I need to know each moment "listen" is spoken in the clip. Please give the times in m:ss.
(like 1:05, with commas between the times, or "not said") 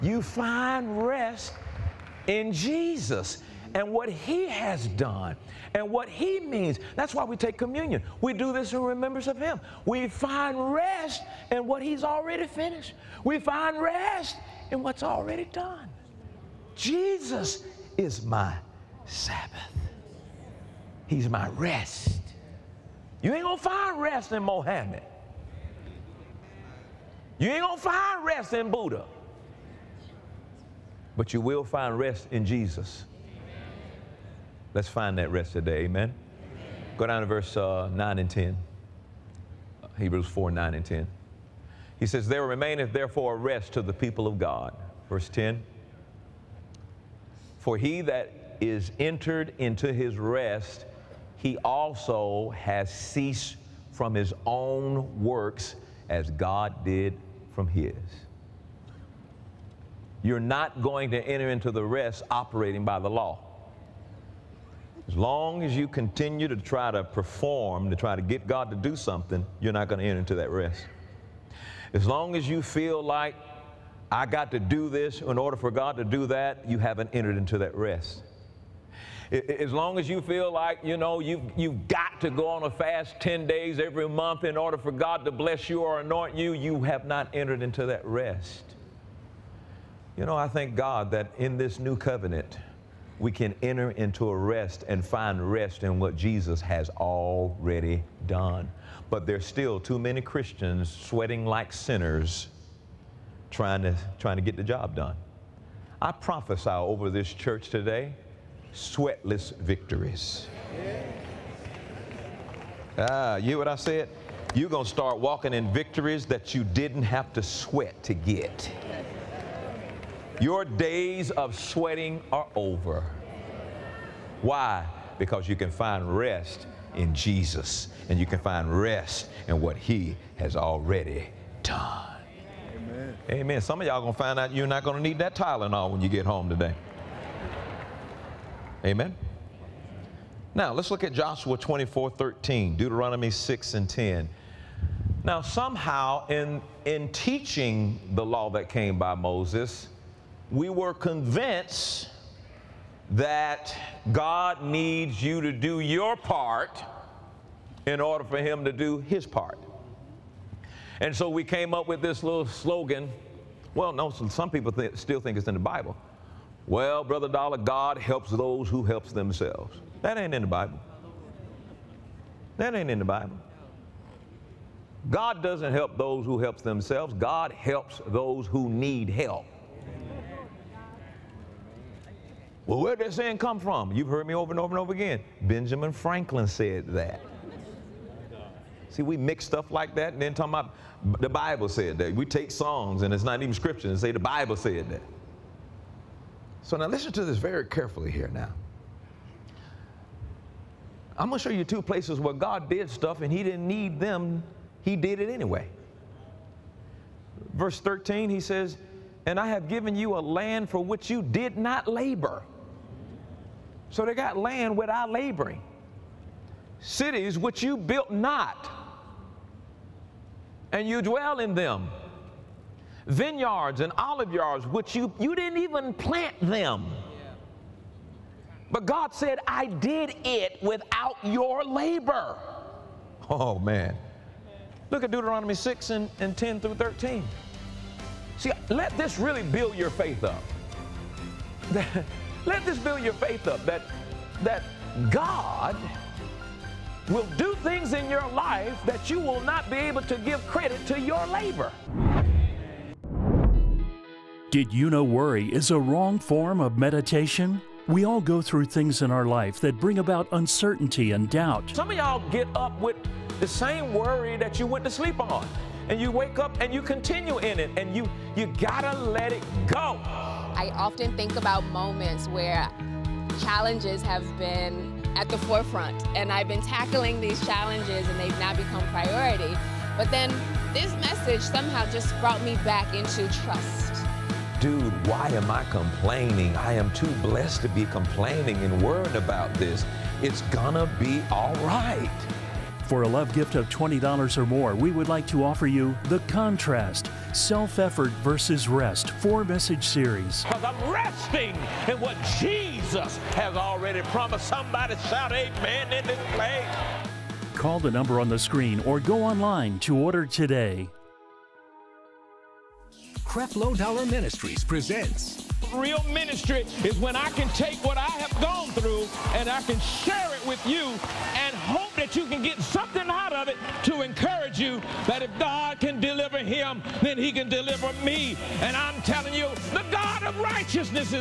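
3:16.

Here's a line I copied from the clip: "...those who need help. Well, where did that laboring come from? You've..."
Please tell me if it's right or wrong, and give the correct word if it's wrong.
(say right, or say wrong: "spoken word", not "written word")
wrong: "saying", not "laboring".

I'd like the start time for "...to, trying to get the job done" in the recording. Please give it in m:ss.
1:43.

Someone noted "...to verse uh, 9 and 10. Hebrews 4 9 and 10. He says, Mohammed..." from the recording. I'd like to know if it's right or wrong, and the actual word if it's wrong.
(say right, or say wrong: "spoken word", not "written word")
wrong: "There", not "Mohammed".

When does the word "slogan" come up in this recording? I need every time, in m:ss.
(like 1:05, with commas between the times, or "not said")
2:42.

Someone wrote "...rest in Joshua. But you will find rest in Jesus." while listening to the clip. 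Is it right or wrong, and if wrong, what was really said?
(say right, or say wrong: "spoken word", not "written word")
wrong: "Buddha", not "Joshua".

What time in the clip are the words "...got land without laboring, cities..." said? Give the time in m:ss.
3:34.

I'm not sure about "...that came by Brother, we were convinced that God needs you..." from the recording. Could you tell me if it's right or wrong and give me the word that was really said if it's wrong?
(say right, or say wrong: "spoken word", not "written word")
wrong: "Moses", not "Brother".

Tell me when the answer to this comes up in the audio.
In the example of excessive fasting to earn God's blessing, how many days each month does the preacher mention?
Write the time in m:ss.
1:23.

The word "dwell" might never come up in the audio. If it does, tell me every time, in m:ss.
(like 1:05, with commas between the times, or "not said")
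3:41.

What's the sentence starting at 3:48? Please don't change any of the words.
But God said, I did it without your labor.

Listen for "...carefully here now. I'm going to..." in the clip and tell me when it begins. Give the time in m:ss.
3:17.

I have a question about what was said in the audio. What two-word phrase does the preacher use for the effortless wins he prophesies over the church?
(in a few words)
Sweatless victories.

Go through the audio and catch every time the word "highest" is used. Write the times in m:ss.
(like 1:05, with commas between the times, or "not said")
not said.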